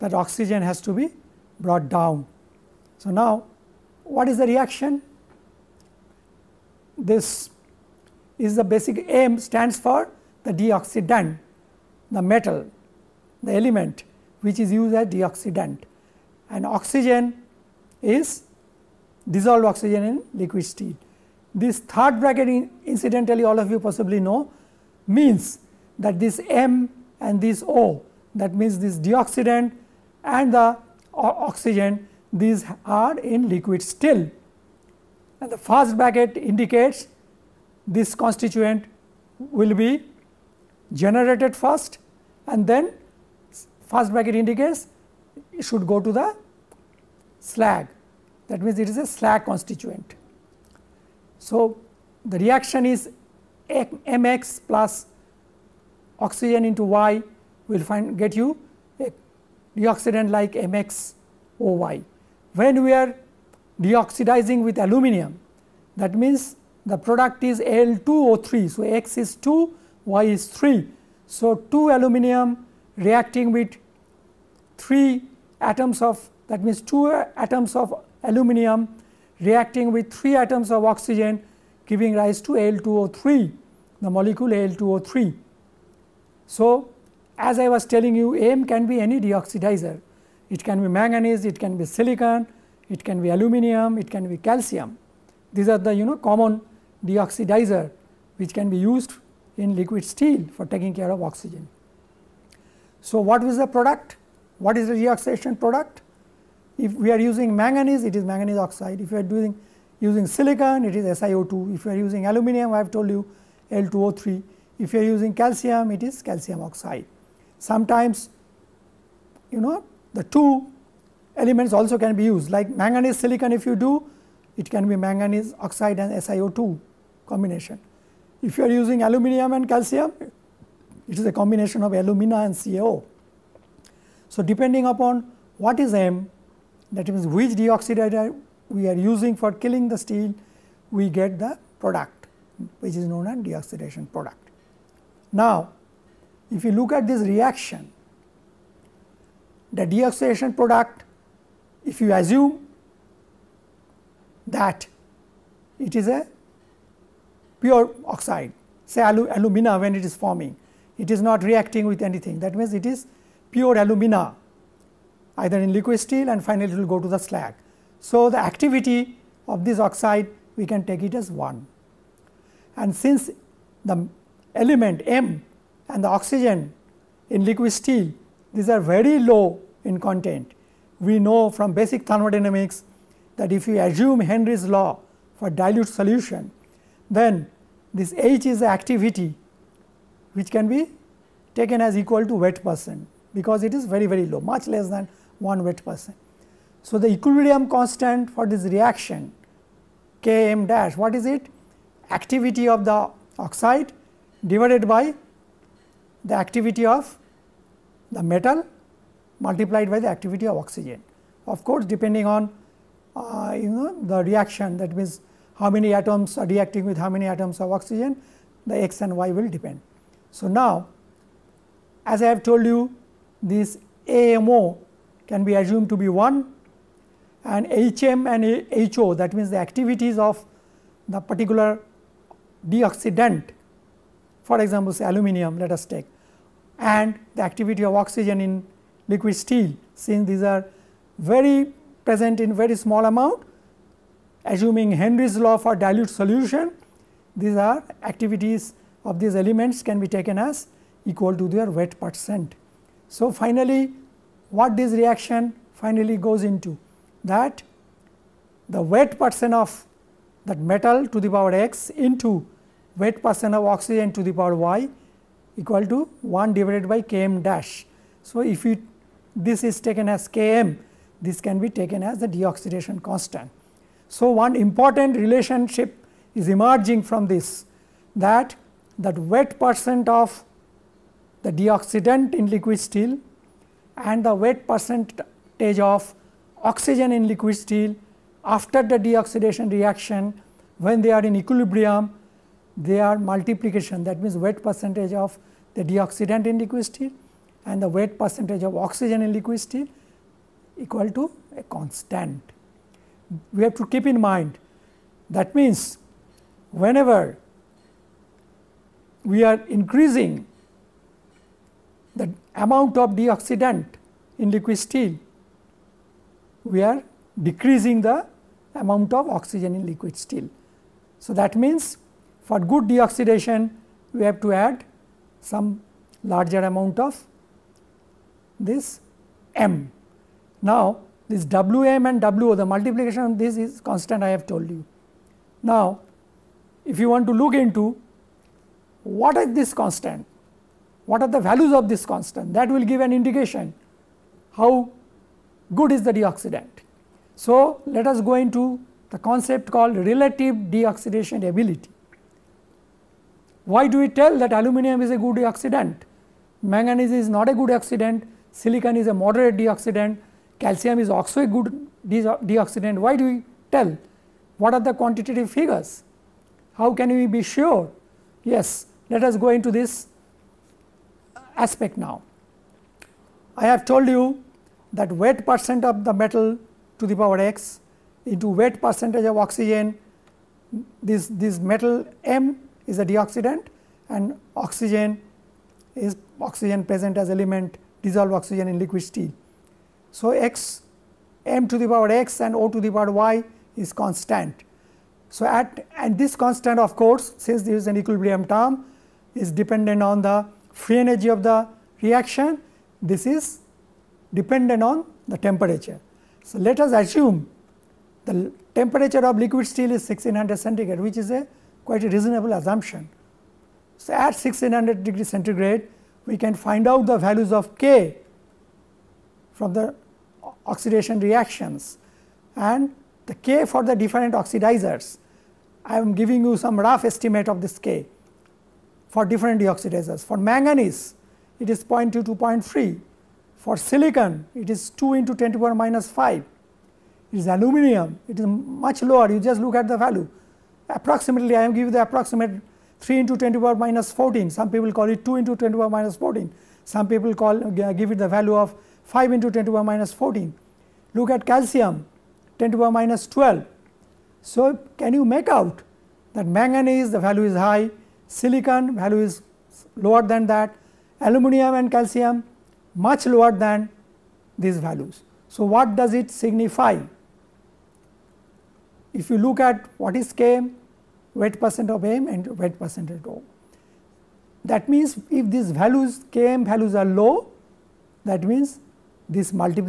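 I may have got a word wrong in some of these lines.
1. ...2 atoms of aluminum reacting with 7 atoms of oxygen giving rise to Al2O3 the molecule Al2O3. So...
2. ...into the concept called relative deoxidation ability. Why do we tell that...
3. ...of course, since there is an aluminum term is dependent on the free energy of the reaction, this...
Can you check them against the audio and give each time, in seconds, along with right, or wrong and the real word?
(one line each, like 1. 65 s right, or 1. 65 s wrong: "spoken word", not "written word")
1. 76 s wrong: "3", not "7"
2. 348 s right
3. 396 s wrong: "equilibrium", not "aluminum".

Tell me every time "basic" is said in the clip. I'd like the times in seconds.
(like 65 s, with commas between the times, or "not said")
8 s, 181 s.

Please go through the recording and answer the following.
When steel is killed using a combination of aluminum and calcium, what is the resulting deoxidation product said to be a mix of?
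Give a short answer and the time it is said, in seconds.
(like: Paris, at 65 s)
alumina and CaO, at 131 s.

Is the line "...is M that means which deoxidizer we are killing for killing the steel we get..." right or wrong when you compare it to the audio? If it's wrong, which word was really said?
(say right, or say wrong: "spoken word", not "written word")
wrong: "using", not "killing".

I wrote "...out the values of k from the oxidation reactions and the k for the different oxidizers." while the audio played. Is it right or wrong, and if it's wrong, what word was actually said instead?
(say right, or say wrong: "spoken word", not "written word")
right.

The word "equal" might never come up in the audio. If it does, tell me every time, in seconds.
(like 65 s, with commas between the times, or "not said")
191 s, 251 s, 265 s, 300 s.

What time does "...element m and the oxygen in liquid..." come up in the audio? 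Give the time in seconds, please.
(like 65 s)
174 s.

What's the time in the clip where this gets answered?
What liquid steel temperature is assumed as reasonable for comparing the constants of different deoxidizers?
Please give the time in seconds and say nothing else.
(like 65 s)
410 s.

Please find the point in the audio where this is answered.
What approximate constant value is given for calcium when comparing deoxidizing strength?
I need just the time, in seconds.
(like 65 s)
452 s.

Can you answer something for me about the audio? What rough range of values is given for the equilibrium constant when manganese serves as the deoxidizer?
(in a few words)
0.2 to 0.3.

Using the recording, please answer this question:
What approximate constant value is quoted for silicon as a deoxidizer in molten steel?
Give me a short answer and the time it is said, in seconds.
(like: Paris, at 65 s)
2 × 10^-5, at 434 s.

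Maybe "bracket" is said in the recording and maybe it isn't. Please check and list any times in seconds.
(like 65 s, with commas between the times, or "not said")
22 s, 35 s, 44 s.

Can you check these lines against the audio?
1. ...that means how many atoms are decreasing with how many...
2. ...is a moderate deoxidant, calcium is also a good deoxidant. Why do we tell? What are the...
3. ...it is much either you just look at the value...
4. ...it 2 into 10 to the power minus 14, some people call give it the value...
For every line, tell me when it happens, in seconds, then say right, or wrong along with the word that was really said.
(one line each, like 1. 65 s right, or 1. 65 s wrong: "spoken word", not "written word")
1. 214 s wrong: "reacting", not "decreasing"
2. 358 s right
3. 438 s wrong: "lower", not "either"
4. 445 s right.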